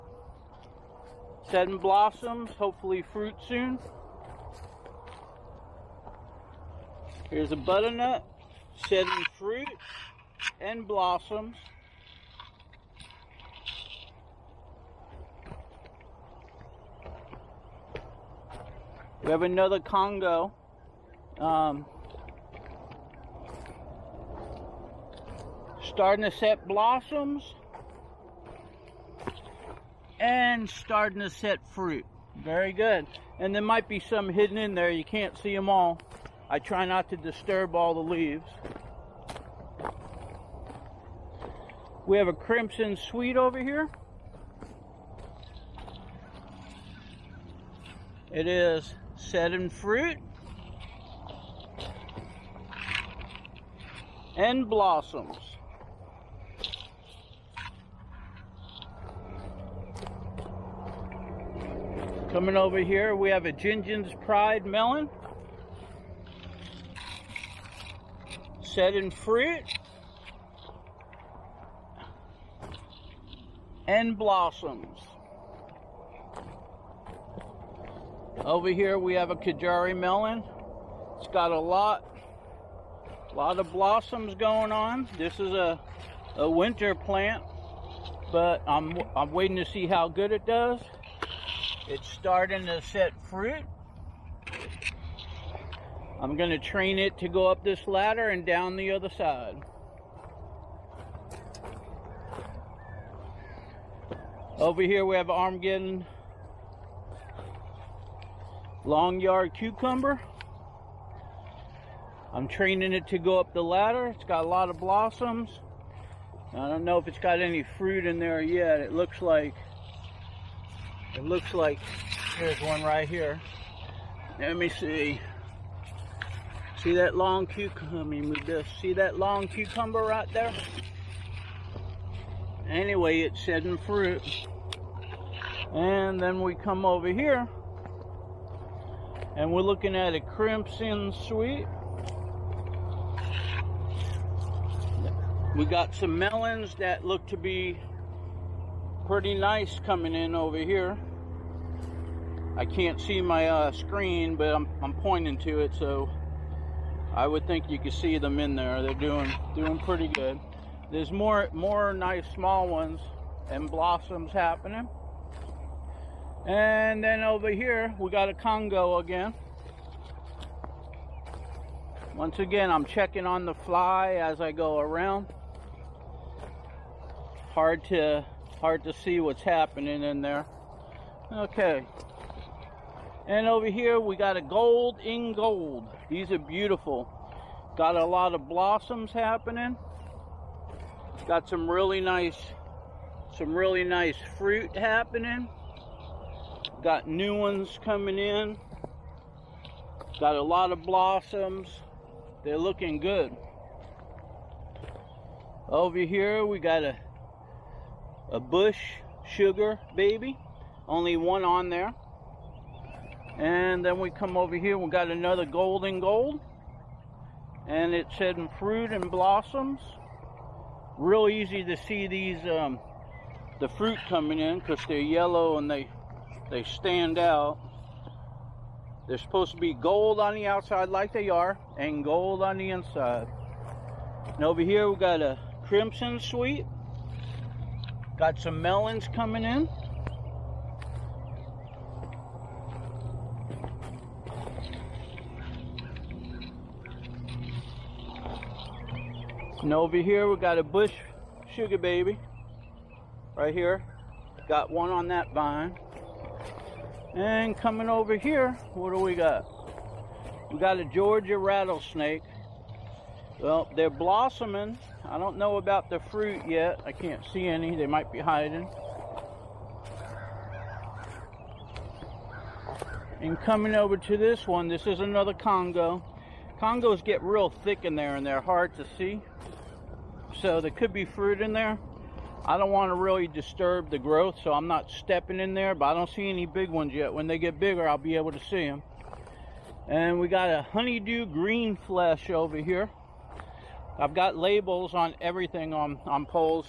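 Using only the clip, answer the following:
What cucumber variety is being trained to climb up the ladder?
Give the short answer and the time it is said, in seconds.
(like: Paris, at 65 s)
Armenian long yard cucumber, at 105 s.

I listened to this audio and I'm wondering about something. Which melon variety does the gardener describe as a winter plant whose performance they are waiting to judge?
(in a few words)
Kajari melon.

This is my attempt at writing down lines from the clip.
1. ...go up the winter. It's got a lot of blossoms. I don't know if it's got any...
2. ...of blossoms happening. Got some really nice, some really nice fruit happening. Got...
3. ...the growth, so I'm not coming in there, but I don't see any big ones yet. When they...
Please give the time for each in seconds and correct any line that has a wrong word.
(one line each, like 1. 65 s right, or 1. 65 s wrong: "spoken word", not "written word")
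1. 113 s wrong: "ladder", not "winter"
2. 188 s right
3. 283 s wrong: "stepping", not "coming".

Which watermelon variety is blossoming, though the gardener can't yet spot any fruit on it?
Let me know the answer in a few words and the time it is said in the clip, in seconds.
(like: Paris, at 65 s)
Georgia rattlesnake, at 260 s.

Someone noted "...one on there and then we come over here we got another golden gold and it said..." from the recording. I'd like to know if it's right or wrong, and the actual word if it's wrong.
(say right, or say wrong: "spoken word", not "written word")
right.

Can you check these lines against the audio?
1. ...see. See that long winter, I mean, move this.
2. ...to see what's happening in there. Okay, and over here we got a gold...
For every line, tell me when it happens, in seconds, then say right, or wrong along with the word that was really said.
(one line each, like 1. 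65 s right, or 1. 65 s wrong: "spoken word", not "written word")
1. 124 s wrong: "cucumber", not "winter"
2. 178 s right.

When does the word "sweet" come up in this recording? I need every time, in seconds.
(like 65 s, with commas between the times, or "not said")
42 s, 141 s, 236 s.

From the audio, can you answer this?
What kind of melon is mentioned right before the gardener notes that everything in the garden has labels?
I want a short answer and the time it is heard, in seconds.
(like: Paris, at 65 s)
honeydew green flesh, at 290 s.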